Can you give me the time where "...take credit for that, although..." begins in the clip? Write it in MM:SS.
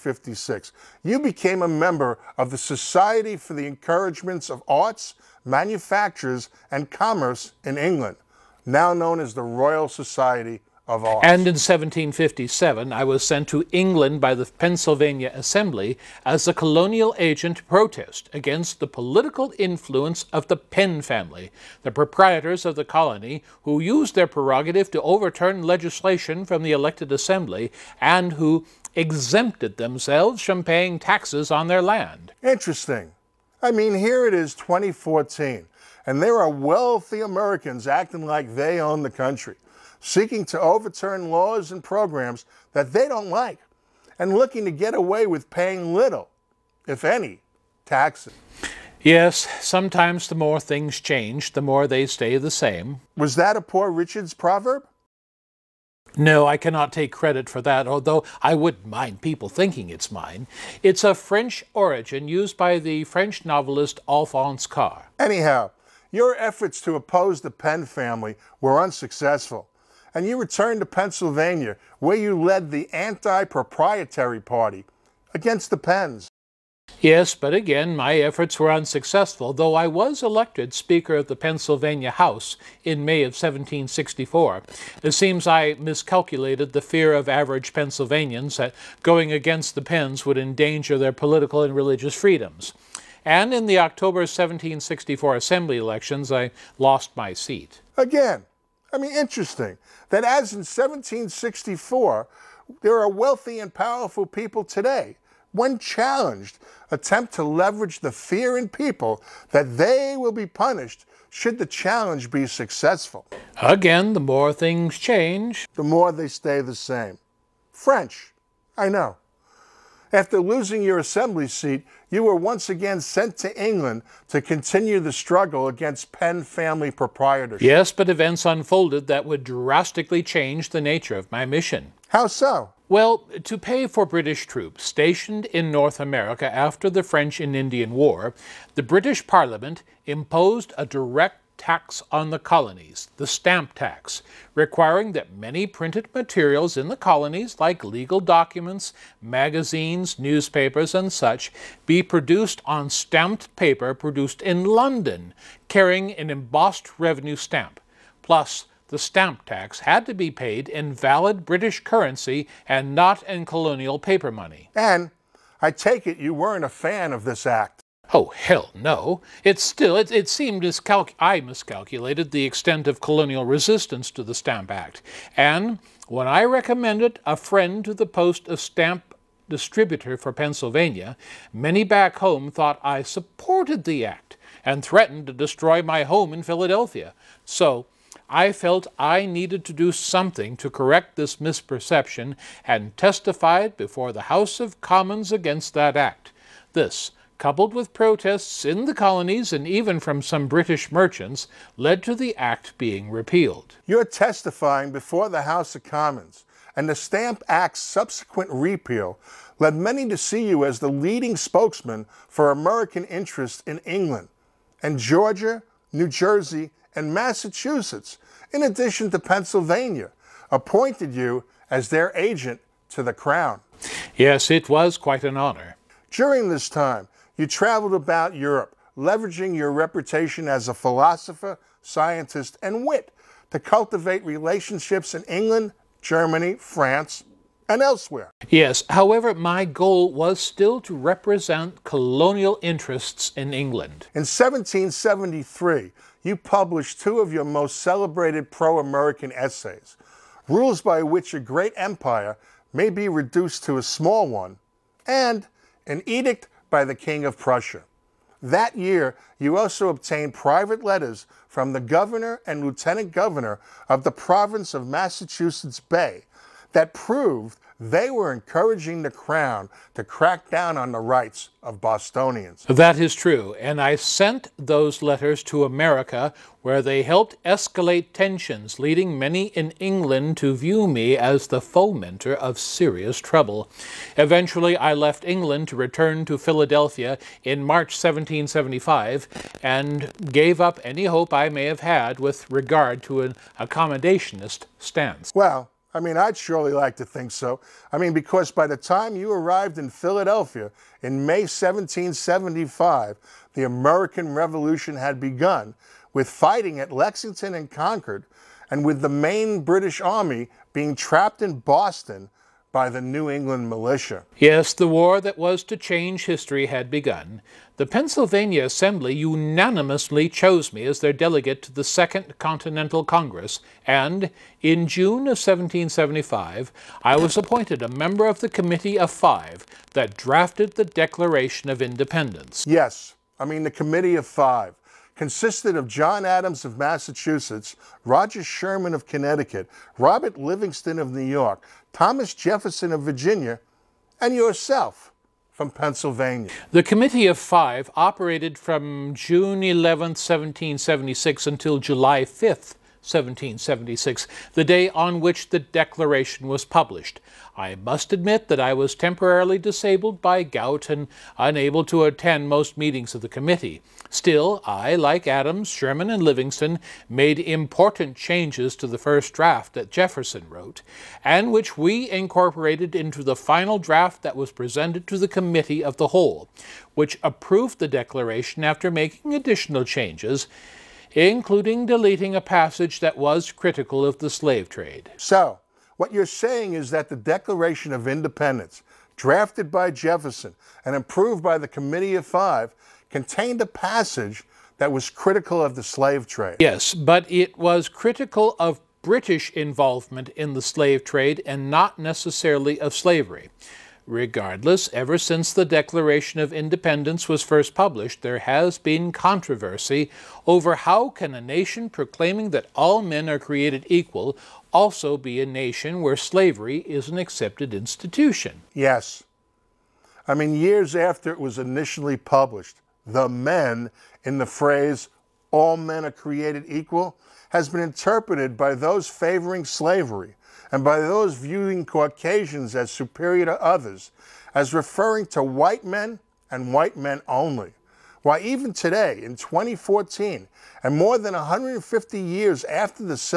00:56.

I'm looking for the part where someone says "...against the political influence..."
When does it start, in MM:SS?
00:18.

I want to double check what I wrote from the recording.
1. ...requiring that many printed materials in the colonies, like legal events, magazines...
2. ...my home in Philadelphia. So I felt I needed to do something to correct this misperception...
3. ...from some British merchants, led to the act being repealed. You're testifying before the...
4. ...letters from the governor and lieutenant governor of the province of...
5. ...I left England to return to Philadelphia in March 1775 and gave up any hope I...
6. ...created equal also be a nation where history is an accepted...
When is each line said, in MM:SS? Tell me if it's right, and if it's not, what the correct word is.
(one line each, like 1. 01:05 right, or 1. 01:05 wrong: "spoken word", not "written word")
1. 02:24 wrong: "documents", not "events"
2. 03:05 right
3. 03:19 right
4. 04:20 right
5. 04:44 right
6. 06:53 wrong: "slavery", not "history".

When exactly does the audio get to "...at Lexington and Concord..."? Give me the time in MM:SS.
05:06.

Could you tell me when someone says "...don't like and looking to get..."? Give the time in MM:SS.
00:43.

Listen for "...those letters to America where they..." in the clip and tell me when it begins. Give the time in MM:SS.
04:34.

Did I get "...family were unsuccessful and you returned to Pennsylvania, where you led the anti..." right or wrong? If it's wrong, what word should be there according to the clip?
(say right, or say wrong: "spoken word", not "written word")
right.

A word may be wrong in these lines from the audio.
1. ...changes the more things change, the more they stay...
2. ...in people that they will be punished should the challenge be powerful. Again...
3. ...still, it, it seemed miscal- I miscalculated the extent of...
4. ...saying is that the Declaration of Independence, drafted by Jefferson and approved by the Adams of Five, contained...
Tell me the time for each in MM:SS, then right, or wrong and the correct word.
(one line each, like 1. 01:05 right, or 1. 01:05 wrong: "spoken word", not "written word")
1. 00:49 wrong: "sometimes", not "changes"
2. 01:48 wrong: "successful", not "powerful"
3. 02:49 right
4. 06:26 wrong: "Committee", not "Adams".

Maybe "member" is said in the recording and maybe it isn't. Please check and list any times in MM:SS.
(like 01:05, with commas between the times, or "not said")
00:01, 05:27.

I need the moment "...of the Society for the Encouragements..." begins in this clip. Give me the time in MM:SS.
00:02.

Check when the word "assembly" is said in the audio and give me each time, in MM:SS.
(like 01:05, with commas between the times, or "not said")
00:15, 00:27, 01:35, 02:00, 05:18.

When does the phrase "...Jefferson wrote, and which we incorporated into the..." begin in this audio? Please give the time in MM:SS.
06:09.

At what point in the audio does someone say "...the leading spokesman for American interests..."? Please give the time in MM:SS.
03:30.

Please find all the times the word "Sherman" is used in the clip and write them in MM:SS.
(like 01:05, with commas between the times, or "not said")
05:38, 06:05.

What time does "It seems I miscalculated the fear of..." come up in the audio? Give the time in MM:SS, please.
01:25.